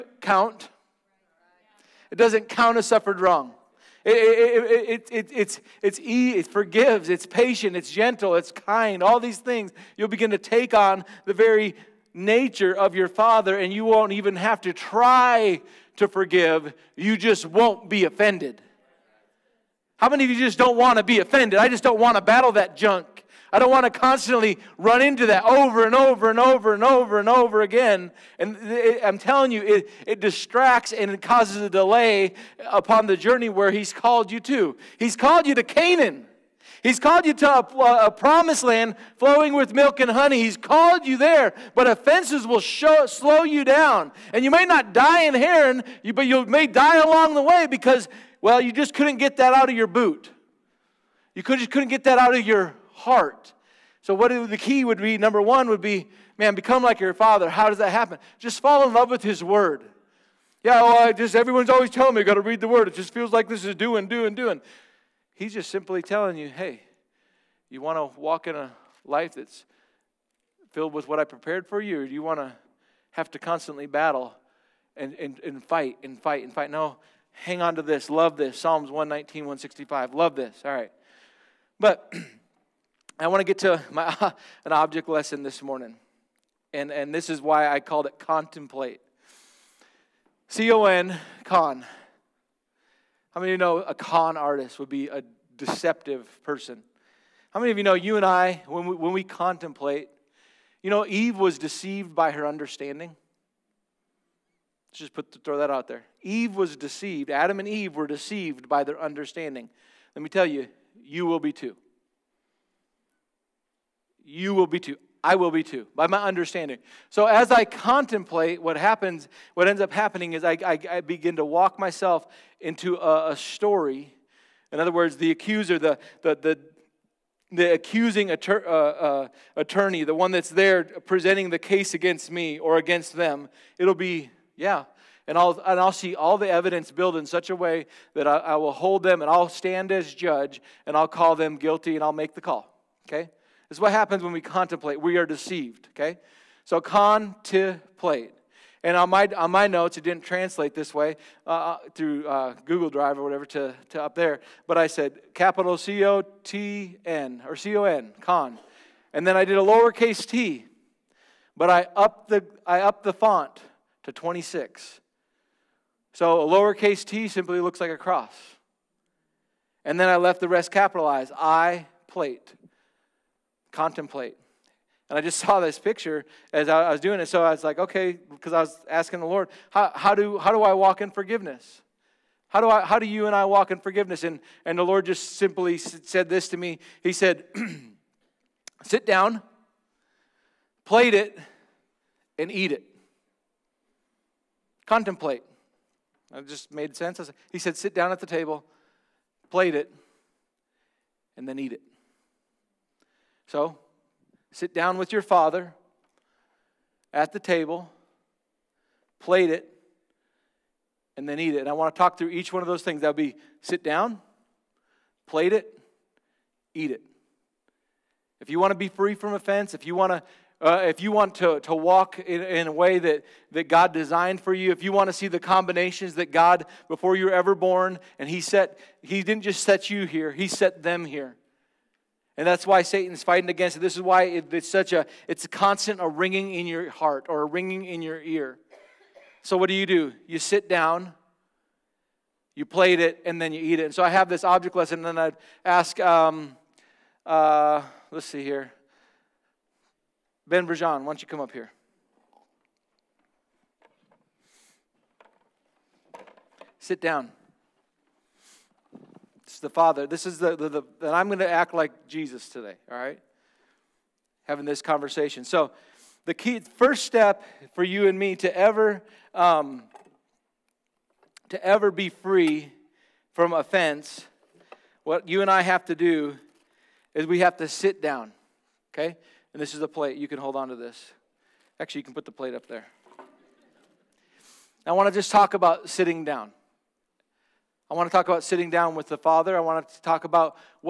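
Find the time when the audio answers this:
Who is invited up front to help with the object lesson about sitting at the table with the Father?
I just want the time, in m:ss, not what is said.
4:10.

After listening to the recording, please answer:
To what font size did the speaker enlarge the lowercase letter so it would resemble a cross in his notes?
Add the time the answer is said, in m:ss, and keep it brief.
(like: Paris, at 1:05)
26, at 2:44.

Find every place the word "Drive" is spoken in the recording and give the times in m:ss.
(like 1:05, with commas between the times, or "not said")
2:32.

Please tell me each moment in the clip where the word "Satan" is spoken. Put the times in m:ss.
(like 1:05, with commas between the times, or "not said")
3:52.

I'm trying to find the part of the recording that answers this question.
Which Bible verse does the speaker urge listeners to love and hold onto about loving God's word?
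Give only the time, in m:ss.
1:18.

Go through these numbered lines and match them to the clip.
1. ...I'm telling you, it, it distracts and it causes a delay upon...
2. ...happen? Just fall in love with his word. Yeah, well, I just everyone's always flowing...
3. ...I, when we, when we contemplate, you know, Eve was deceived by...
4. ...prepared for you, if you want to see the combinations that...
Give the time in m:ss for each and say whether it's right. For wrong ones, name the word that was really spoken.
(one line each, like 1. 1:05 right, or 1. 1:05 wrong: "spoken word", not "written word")
1. 0:29 right
2. 0:57 wrong: "telling", not "flowing"
3. 1:38 right
4. 3:43 wrong: "designed", not "prepared".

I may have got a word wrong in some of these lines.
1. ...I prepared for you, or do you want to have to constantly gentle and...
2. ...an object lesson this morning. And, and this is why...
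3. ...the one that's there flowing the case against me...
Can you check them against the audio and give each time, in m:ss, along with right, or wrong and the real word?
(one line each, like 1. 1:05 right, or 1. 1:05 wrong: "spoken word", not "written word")
1. 1:11 wrong: "battle", not "gentle"
2. 1:24 right
3. 2:10 wrong: "presenting", not "flowing".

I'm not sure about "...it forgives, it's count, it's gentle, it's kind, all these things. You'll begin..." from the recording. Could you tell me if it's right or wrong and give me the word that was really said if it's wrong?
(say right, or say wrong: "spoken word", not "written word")
wrong: "patient", not "count".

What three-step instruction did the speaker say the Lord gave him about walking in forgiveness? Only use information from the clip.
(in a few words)
Sit down, plate it, eat it.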